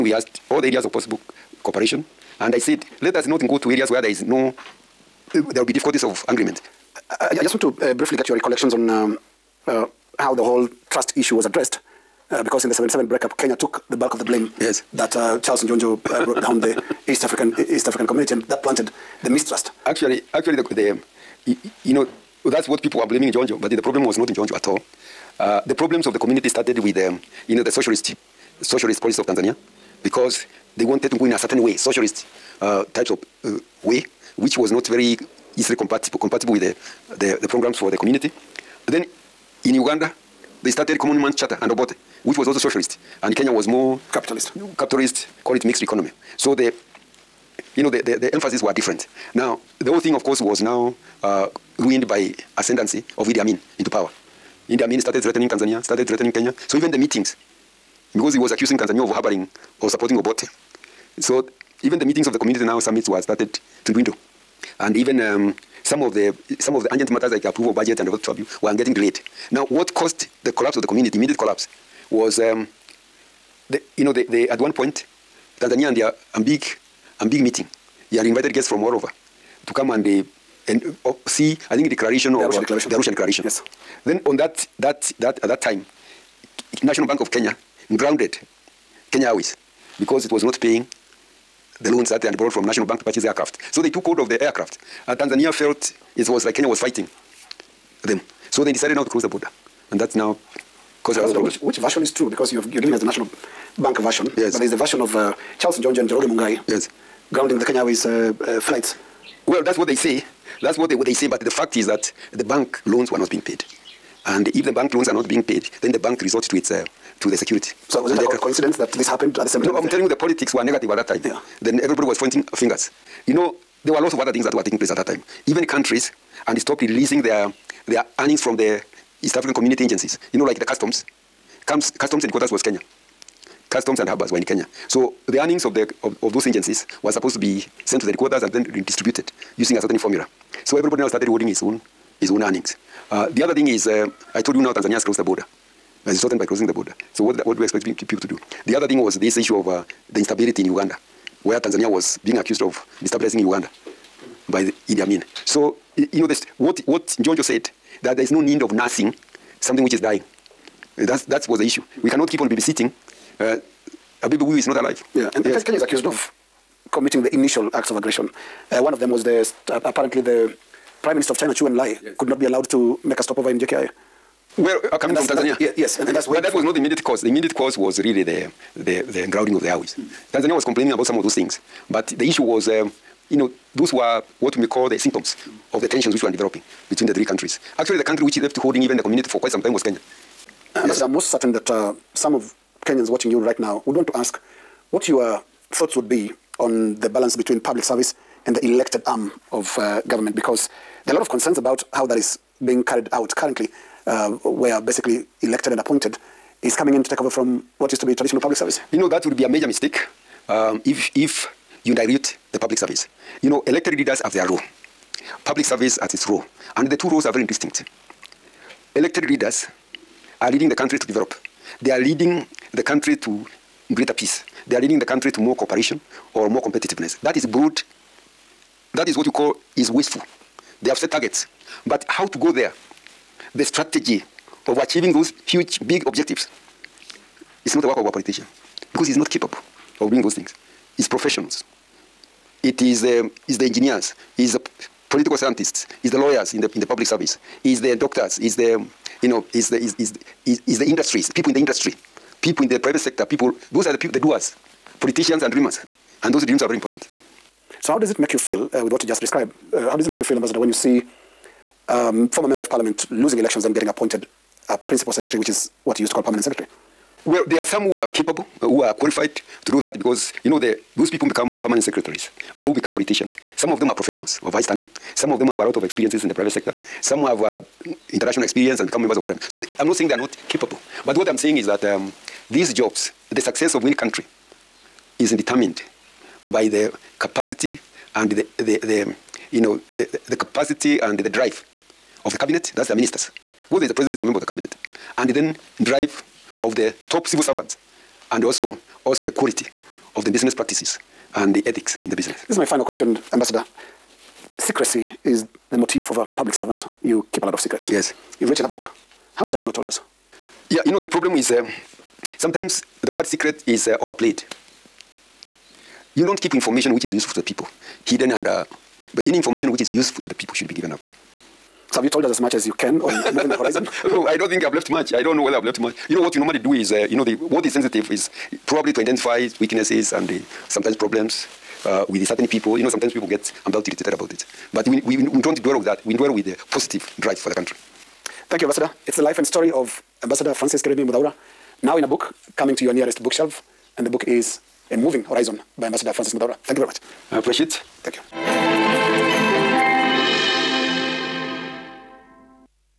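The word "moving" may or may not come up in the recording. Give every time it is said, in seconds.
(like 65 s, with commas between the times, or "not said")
323 s, 344 s.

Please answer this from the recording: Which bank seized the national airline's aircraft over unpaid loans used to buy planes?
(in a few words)
National Bank of Kenya.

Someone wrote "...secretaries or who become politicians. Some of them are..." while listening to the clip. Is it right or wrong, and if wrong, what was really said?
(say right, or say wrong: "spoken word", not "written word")
right.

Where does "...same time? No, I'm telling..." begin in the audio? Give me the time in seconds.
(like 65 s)
119 s.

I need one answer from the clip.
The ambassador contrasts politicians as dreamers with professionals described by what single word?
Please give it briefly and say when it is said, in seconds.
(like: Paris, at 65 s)
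doers, at 254 s.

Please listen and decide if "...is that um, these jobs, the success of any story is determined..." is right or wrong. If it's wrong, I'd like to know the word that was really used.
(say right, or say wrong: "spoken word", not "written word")
wrong: "country", not "story".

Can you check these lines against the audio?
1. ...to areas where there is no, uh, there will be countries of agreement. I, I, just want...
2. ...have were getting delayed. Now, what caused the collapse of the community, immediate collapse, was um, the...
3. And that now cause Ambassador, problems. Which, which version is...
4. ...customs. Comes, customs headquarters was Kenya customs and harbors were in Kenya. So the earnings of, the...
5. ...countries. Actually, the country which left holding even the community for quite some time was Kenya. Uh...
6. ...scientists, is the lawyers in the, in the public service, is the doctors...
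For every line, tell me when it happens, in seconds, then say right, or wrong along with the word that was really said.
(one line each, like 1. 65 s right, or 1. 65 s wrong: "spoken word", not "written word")
1. 3 s wrong: "difficulties", not "countries"
2. 68 s right
3. 99 s right
4. 130 s right
5. 187 s right
6. 245 s right.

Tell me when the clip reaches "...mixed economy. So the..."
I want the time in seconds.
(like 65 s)
45 s.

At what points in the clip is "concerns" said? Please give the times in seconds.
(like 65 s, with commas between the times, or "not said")
201 s.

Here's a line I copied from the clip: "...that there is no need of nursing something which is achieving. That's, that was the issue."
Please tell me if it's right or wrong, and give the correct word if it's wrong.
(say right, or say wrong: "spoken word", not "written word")
wrong: "dying", not "achieving".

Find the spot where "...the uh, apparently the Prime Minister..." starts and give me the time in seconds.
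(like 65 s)
169 s.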